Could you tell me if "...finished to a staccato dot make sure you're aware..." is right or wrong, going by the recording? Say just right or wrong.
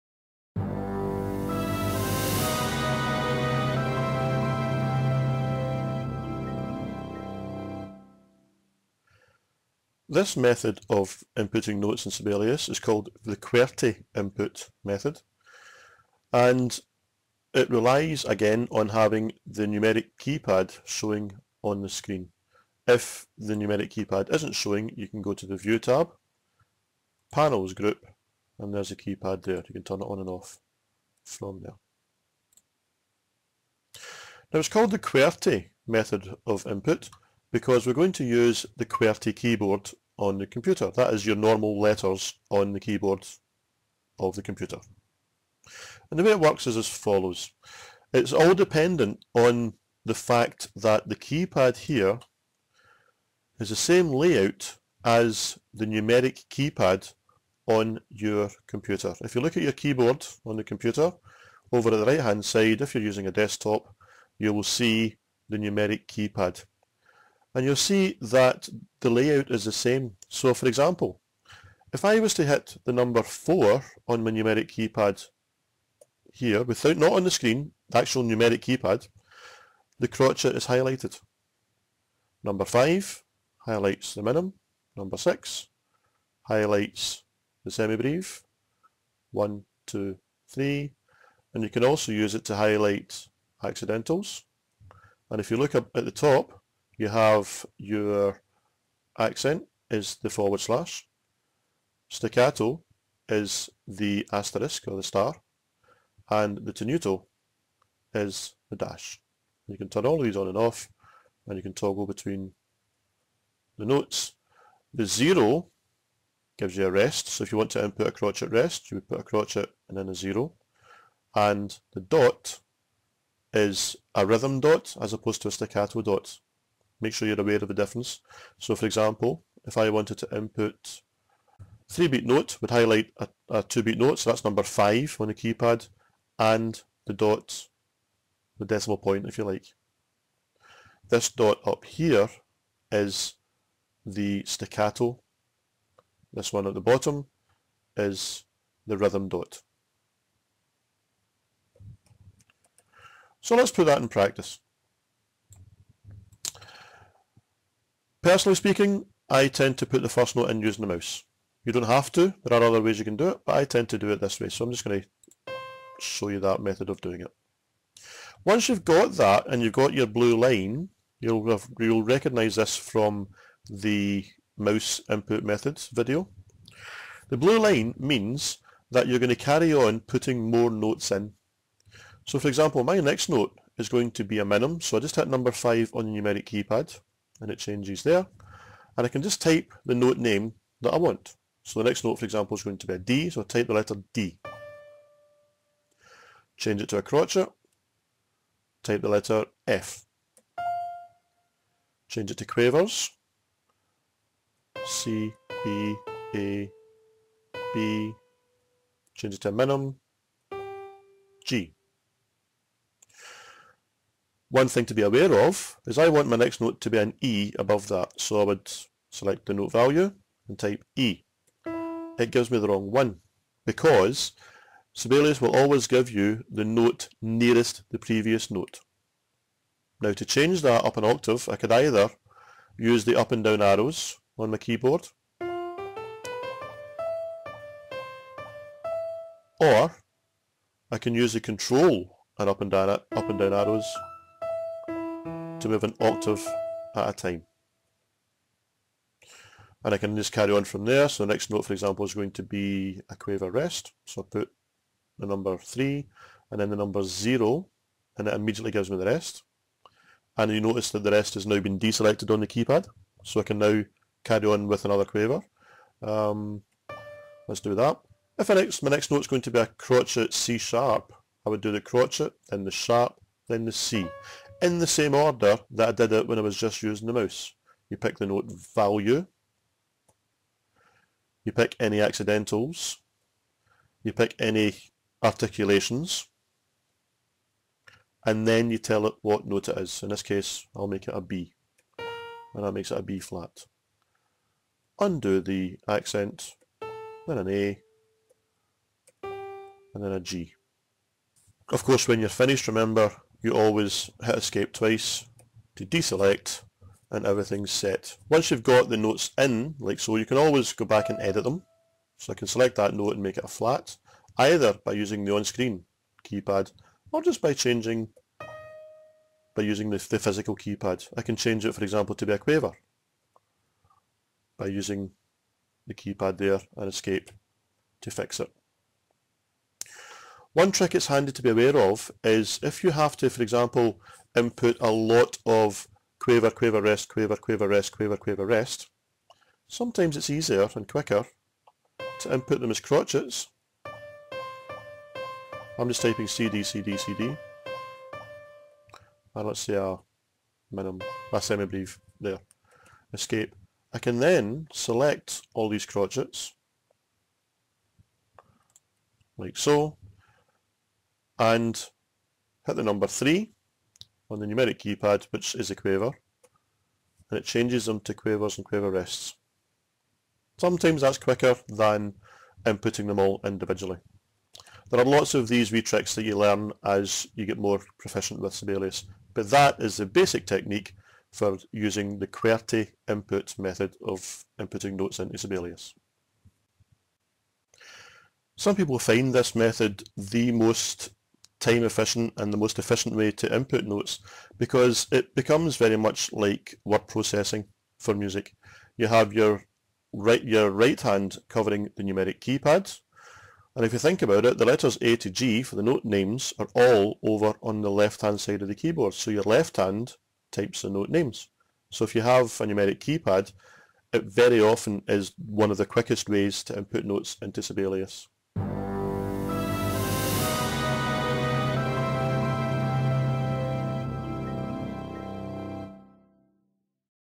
wrong.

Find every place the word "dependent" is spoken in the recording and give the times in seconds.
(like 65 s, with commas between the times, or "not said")
48 s.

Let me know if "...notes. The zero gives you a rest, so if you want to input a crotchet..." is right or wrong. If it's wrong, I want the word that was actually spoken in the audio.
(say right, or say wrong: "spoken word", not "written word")
right.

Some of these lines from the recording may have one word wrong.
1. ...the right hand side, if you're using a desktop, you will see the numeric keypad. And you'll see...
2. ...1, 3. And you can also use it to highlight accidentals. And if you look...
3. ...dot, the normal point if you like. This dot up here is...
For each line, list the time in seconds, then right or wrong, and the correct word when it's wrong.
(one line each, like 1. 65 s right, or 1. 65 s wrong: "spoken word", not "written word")
1. 61 s right
2. 89 s wrong: "2", not "1"
3. 137 s wrong: "decimal", not "normal".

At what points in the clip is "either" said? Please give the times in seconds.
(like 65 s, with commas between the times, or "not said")
231 s, 314 s.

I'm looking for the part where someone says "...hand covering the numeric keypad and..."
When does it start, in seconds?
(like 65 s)
400 s.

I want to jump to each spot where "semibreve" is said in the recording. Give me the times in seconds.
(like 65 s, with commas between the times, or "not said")
87 s, 351 s.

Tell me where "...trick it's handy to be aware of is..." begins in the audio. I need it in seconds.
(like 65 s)
330 s.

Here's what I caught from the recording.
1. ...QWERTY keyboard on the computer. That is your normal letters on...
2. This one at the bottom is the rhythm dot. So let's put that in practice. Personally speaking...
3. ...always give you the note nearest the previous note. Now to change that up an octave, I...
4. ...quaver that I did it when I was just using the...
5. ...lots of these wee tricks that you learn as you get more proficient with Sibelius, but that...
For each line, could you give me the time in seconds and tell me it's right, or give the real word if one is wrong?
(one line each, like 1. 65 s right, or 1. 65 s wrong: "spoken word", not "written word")
1. 38 s right
2. 146 s right
3. 225 s right
4. 275 s wrong: "order", not "quaver"
5. 375 s right.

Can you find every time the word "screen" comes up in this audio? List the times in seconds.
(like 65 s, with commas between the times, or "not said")
21 s, 77 s, 315 s.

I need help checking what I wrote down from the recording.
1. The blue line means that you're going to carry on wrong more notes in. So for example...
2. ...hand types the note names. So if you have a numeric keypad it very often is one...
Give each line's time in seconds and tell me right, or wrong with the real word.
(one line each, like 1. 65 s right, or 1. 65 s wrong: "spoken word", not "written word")
1. 177 s wrong: "putting", not "wrong"
2. 409 s right.